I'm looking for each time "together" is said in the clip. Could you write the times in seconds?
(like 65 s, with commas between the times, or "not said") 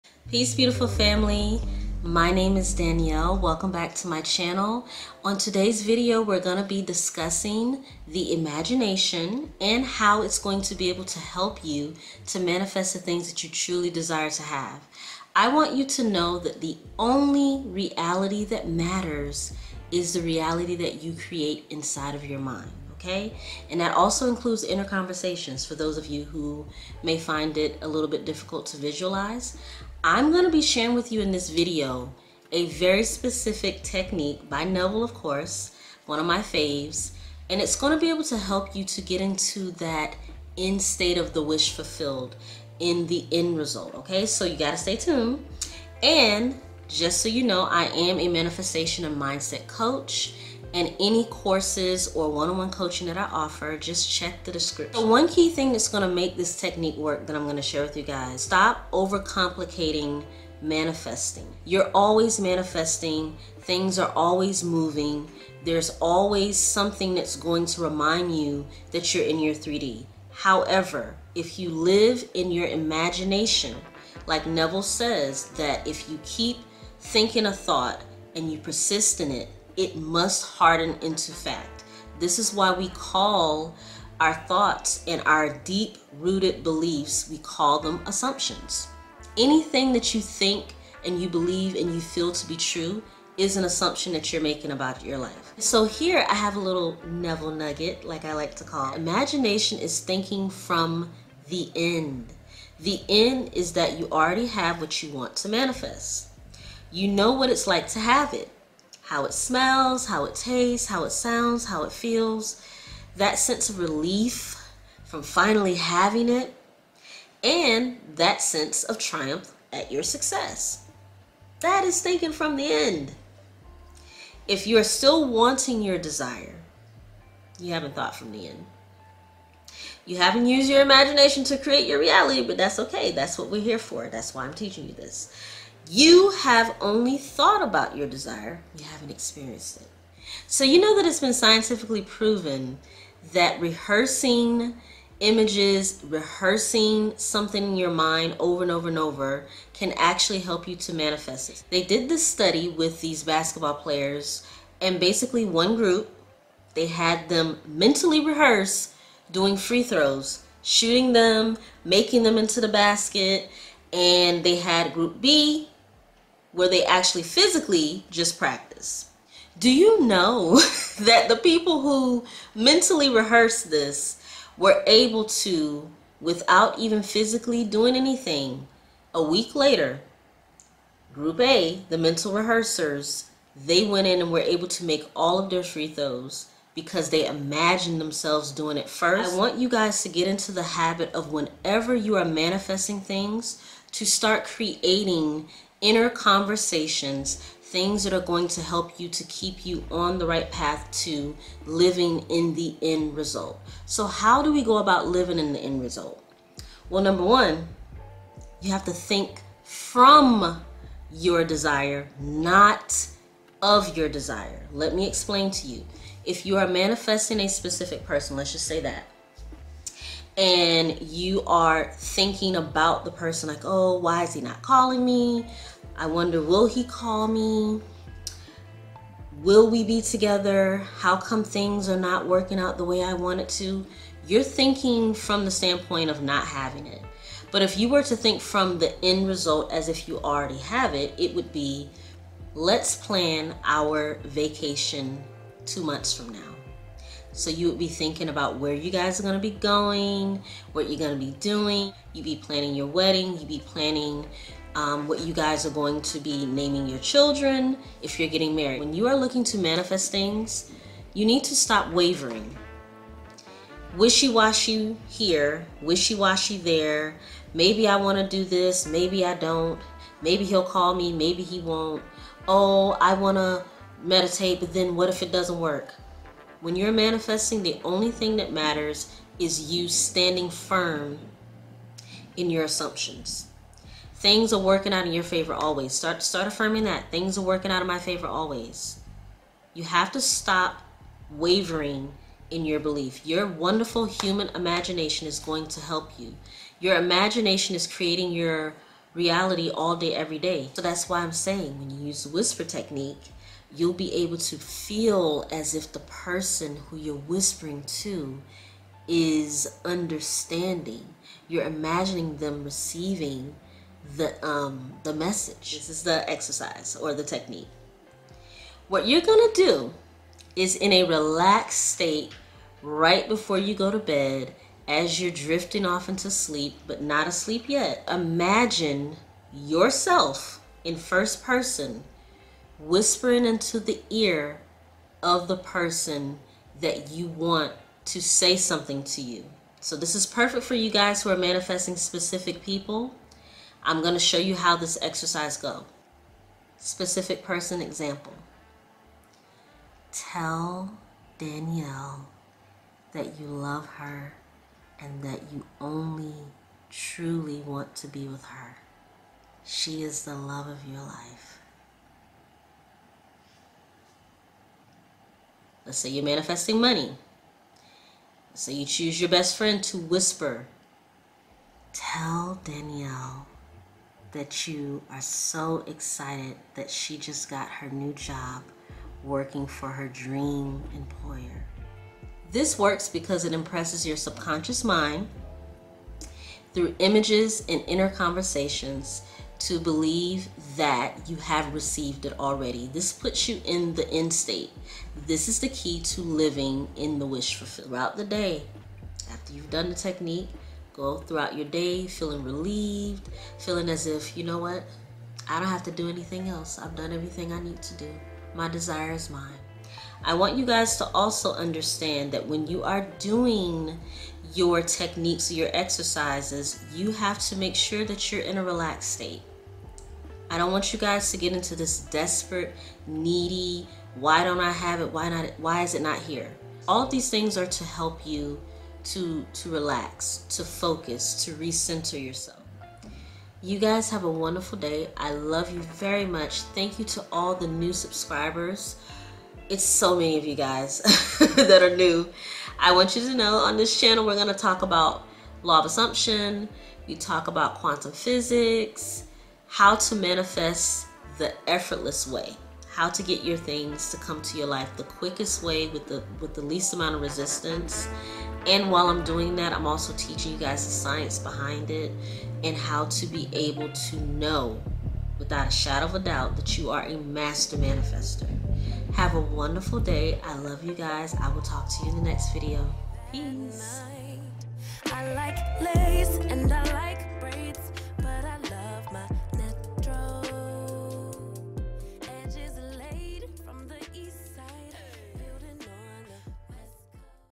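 230 s.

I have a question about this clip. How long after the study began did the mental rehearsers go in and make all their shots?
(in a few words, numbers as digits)
a week later.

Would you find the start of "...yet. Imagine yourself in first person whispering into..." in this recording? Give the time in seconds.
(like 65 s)
327 s.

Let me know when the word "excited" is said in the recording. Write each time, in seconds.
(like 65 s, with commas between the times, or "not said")
375 s.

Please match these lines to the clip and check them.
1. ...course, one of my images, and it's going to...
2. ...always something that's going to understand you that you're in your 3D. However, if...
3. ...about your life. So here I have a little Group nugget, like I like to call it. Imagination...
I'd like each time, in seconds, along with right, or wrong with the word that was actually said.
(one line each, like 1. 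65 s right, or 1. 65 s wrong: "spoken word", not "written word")
1. 35 s wrong: "faves", not "images"
2. 65 s wrong: "remind", not "understand"
3. 94 s wrong: "Neville", not "Group".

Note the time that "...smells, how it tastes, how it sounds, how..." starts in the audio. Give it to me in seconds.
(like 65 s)
109 s.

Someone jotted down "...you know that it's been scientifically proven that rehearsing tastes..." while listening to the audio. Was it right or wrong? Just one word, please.
wrong.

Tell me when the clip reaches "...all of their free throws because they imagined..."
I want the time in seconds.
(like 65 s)
185 s.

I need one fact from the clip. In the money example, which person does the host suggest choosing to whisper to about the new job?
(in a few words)
best friend.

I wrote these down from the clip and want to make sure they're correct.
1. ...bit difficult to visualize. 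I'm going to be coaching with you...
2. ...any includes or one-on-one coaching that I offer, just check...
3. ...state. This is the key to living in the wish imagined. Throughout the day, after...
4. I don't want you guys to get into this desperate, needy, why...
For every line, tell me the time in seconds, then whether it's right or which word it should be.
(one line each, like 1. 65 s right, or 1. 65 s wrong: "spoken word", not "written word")
1. 28 s wrong: "sharing", not "coaching"
2. 50 s wrong: "courses", not "includes"
3. 394 s wrong: "fulfilled", not "imagined"
4. 420 s right.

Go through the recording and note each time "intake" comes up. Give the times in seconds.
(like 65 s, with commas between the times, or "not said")
not said.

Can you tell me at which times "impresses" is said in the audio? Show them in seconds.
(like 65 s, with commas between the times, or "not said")
383 s.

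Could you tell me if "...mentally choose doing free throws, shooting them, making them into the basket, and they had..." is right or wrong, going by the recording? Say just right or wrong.
wrong.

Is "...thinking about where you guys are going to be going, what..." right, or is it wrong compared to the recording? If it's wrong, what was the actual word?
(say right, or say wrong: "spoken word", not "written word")
right.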